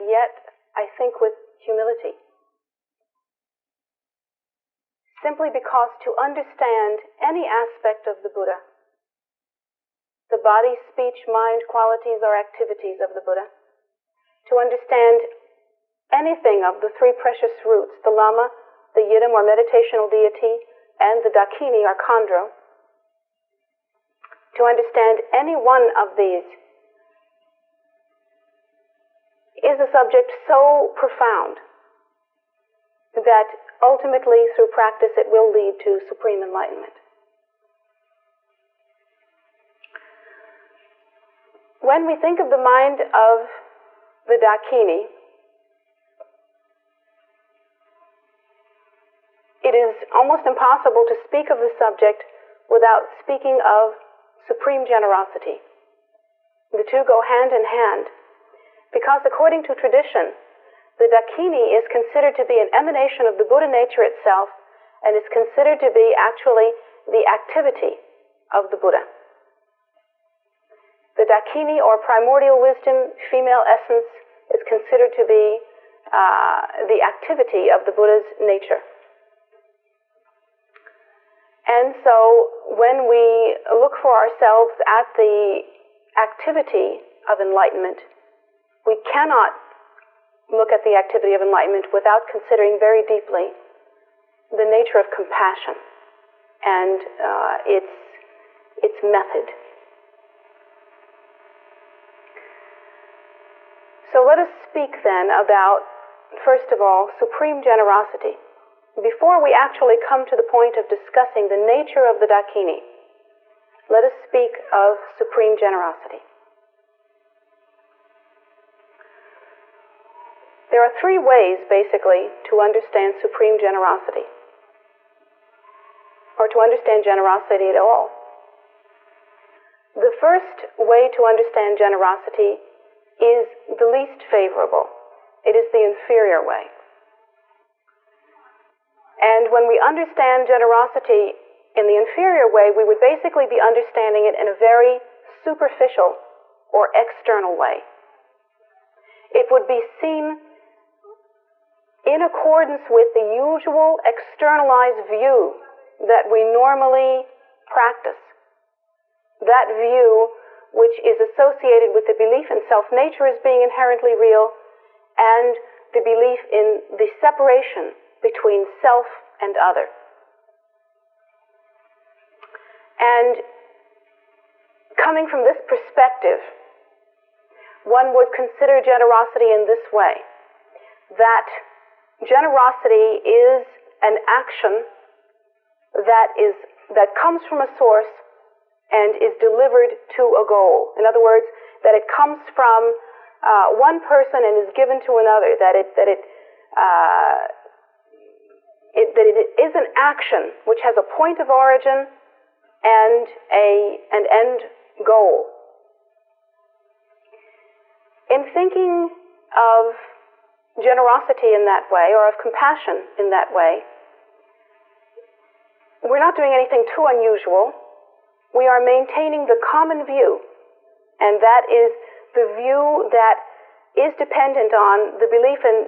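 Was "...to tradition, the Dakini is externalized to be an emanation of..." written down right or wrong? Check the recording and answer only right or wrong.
wrong.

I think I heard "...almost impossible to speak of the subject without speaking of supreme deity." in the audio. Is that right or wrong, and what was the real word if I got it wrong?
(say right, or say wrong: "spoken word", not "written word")
wrong: "generosity", not "deity".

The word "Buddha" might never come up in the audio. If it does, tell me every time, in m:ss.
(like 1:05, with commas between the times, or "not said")
0:08, 0:13, 1:03, 1:08, 1:17.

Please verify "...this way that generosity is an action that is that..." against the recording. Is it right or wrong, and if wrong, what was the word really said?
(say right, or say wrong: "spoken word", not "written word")
right.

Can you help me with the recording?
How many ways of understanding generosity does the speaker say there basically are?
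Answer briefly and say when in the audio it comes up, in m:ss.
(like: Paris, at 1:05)
3, at 2:00.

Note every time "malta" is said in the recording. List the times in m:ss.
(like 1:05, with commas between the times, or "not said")
not said.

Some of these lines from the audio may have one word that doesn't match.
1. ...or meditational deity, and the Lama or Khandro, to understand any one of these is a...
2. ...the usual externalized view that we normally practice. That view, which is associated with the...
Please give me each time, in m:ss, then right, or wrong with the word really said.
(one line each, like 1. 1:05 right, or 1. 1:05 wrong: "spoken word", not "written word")
1. 0:19 wrong: "Dakini", not "Lama"
2. 2:33 right.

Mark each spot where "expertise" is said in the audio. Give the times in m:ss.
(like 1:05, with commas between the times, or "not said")
not said.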